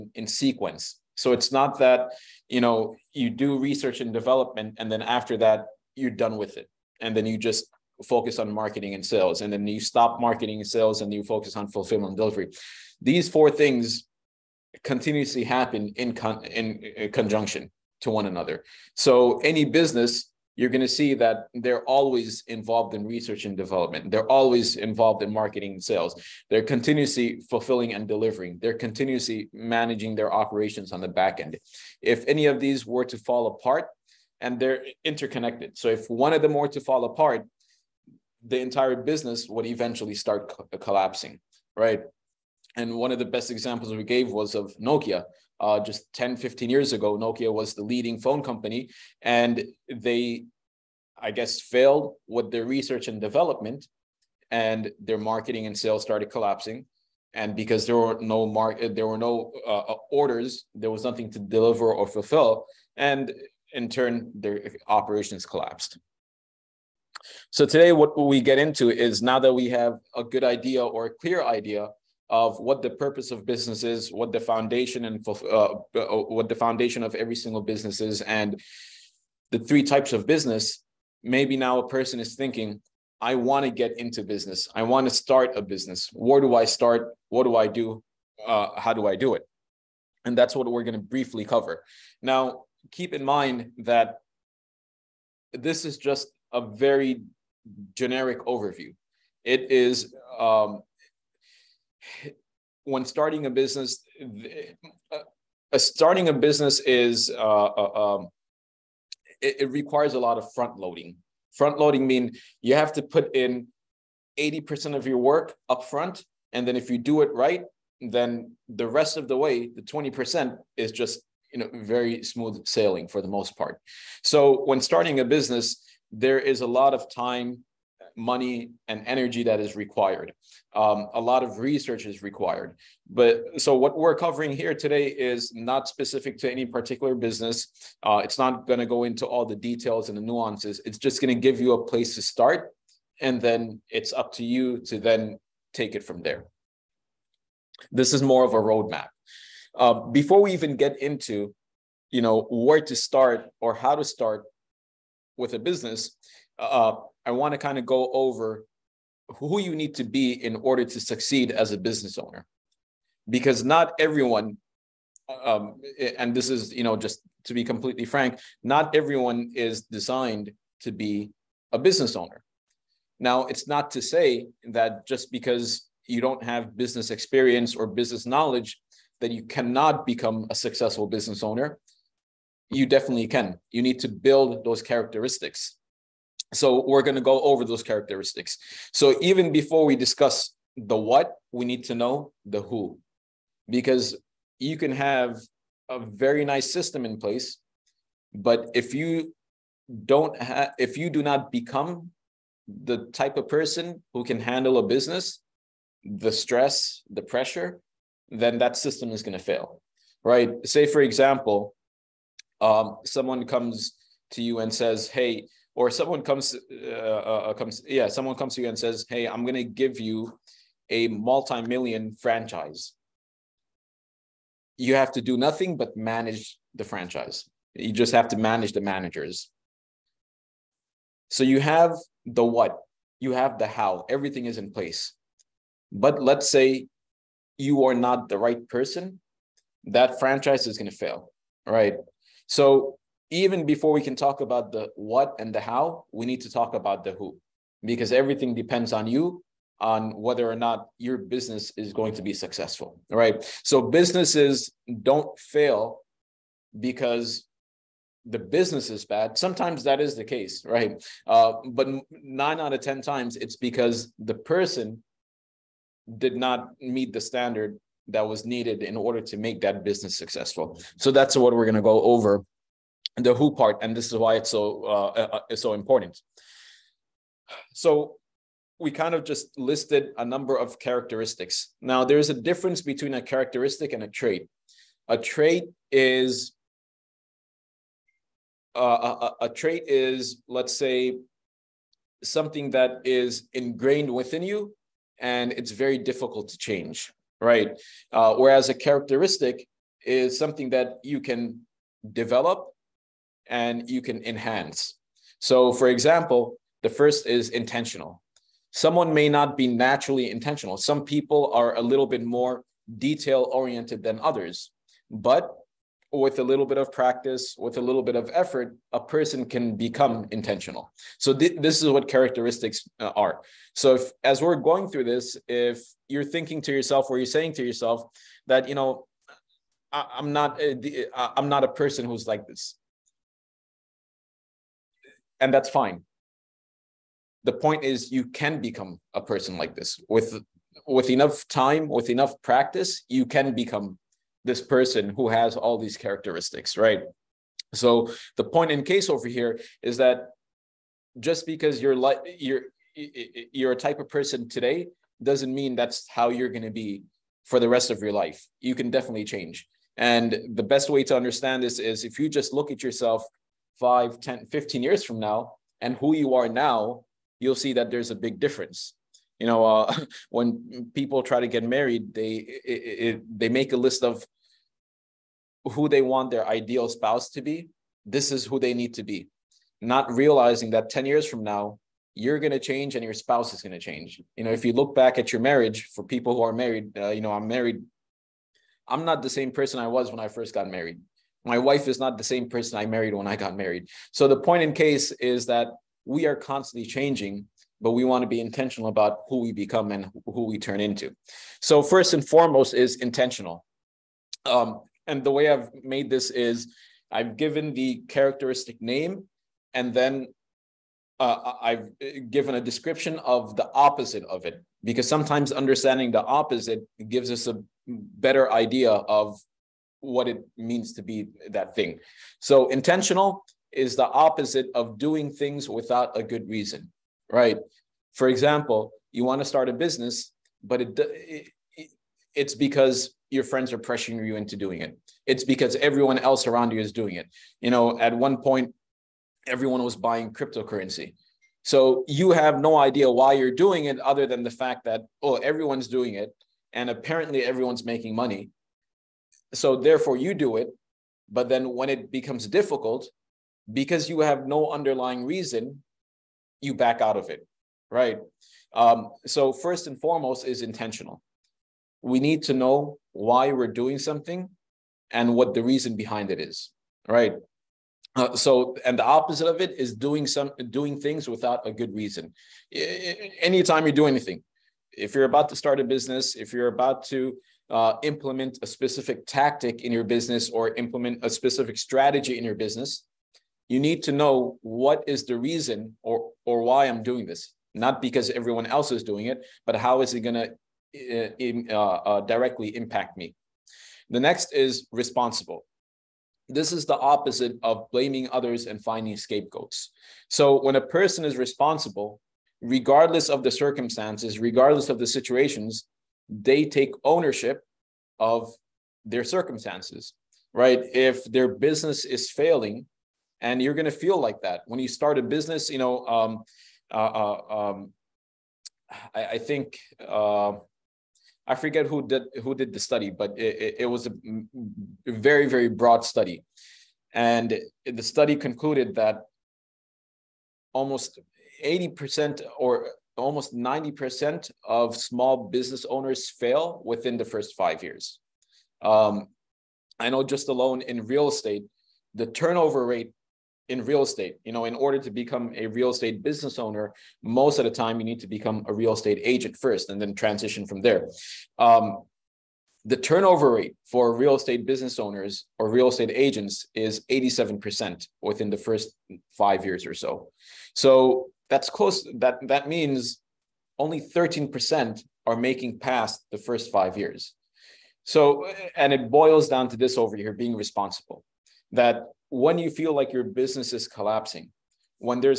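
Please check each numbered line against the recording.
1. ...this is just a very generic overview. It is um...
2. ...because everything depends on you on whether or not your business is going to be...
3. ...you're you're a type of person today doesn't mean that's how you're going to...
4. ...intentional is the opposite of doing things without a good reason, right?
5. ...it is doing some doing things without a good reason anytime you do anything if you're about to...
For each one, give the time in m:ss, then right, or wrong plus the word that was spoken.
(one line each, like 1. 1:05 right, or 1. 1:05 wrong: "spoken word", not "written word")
1. 1:35 right
2. 4:07 right
3. 5:52 right
4. 7:02 right
5. 7:49 right.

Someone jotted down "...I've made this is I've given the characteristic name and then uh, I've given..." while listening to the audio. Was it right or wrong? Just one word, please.
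right.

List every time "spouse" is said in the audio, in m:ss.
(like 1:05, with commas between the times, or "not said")
6:16, 6:23.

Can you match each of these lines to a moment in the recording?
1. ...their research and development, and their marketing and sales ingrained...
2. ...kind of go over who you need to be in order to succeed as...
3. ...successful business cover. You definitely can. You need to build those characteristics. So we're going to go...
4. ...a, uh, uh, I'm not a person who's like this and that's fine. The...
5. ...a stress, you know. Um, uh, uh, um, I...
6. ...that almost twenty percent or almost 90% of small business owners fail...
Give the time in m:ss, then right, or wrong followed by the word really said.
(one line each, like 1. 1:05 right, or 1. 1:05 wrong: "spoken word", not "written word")
1. 0:52 wrong: "started", not "ingrained"
2. 2:37 right
3. 3:00 wrong: "owner", not "cover"
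4. 5:30 right
5. 8:35 wrong: "business", not "stress"
6. 8:48 wrong: "eighty", not "twenty".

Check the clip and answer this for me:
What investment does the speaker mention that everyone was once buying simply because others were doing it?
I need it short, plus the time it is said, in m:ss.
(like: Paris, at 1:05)
Cryptocurrency, at 7:20.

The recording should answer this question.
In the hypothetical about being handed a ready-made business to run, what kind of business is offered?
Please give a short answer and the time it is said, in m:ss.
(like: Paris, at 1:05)
multi-million franchise, at 3:41.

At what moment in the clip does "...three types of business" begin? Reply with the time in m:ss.
1:19.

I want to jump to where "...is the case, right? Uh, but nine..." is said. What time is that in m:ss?
4:19.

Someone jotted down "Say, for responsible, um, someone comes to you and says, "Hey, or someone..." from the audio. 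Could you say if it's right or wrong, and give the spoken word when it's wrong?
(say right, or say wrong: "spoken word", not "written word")
wrong: "example", not "responsible".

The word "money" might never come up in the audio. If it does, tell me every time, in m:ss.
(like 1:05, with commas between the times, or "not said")
2:08, 7:28.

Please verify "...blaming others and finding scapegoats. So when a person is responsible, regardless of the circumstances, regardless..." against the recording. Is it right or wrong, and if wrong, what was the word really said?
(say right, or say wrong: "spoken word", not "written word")
right.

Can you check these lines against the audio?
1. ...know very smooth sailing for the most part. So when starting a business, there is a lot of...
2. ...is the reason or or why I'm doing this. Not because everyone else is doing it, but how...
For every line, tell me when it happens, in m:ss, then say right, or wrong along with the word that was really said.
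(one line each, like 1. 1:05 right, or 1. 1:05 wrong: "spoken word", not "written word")
1. 2:01 right
2. 8:05 right.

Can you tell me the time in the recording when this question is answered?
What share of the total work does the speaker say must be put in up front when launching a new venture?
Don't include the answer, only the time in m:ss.
1:54.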